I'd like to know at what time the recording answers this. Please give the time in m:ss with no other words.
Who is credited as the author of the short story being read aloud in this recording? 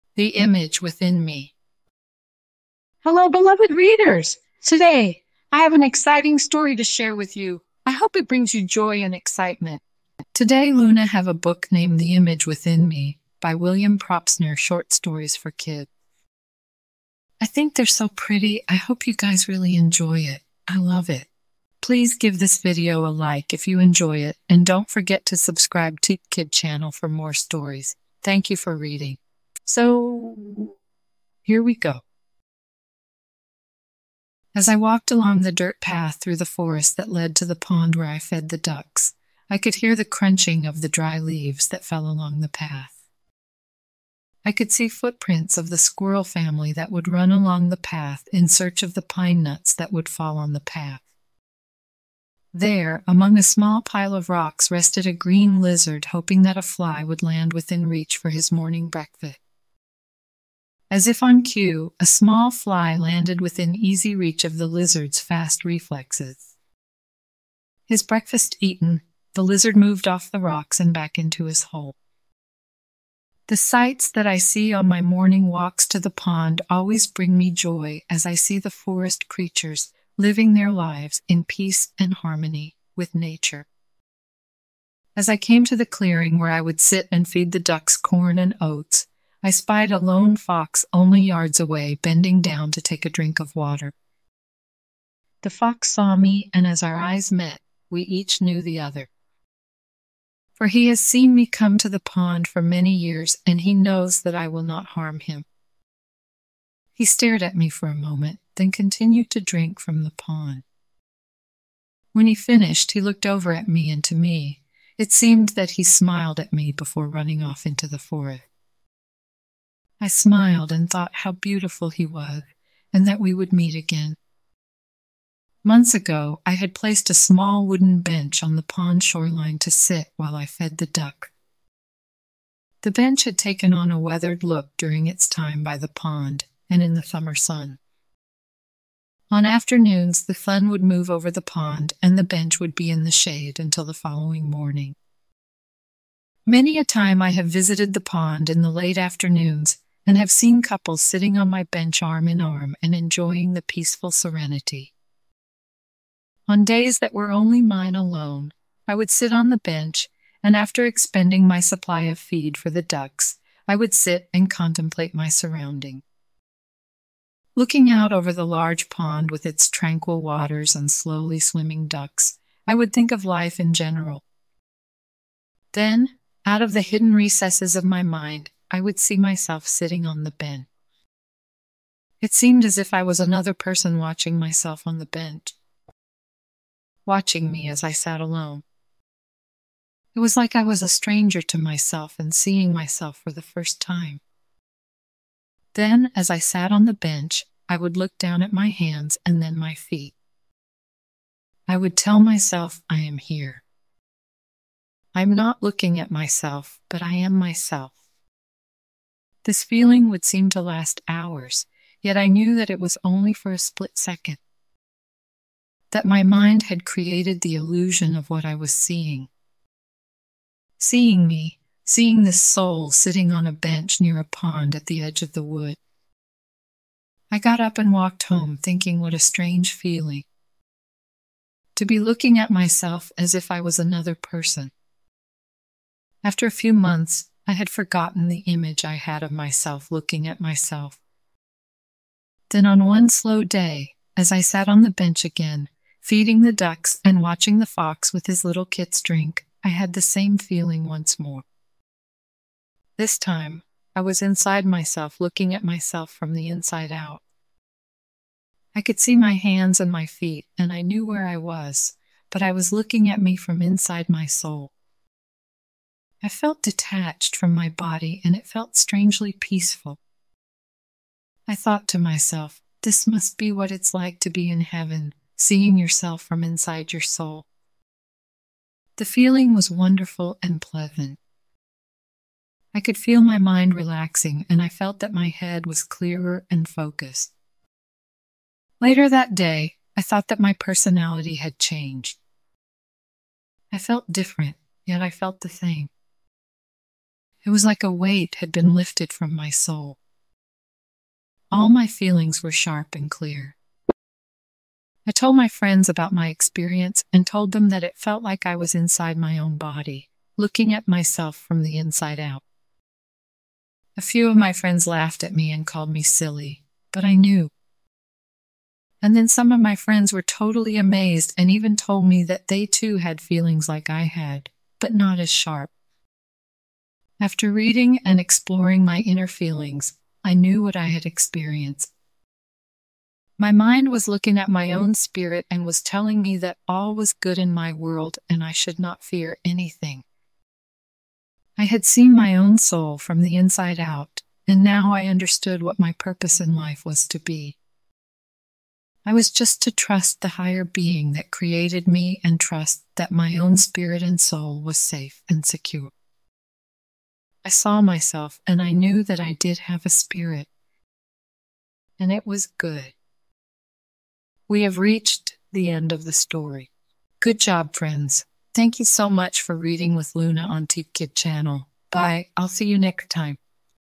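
0:13.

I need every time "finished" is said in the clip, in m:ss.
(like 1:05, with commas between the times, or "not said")
1:52.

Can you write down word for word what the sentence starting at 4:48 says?
Later that day, I thought that my personality had changed.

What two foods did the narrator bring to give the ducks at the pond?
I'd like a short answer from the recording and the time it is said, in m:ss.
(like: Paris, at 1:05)
corn and oats, at 1:27.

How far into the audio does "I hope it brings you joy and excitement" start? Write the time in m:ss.
0:07.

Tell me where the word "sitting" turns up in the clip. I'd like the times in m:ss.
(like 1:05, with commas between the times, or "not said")
2:31, 2:59, 3:42.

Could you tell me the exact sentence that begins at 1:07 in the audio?
His breakfast eaten, the lizard moved off the rocks and back into his hole.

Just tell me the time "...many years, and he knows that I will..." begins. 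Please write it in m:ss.
1:42.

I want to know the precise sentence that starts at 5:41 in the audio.
I had seen my own soul from the inside out, and now I understood what my purpose in life was to be.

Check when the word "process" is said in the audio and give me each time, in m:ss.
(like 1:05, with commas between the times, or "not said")
not said.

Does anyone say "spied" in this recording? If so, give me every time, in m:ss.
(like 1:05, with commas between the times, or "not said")
1:29.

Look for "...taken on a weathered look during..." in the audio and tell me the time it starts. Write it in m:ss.
2:13.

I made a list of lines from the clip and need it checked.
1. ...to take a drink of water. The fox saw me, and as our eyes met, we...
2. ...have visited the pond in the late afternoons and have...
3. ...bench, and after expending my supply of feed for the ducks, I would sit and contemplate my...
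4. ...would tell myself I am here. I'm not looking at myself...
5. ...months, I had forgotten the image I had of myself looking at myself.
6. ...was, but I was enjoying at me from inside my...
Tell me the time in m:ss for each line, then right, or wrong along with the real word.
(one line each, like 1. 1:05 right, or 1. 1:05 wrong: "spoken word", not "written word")
1. 1:32 right
2. 2:27 right
3. 2:39 right
4. 3:21 right
5. 3:56 right
6. 4:21 wrong: "looking", not "enjoying".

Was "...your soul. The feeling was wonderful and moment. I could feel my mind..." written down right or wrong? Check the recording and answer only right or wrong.
wrong.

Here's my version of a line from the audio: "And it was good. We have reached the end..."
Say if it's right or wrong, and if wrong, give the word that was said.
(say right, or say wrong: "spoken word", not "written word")
right.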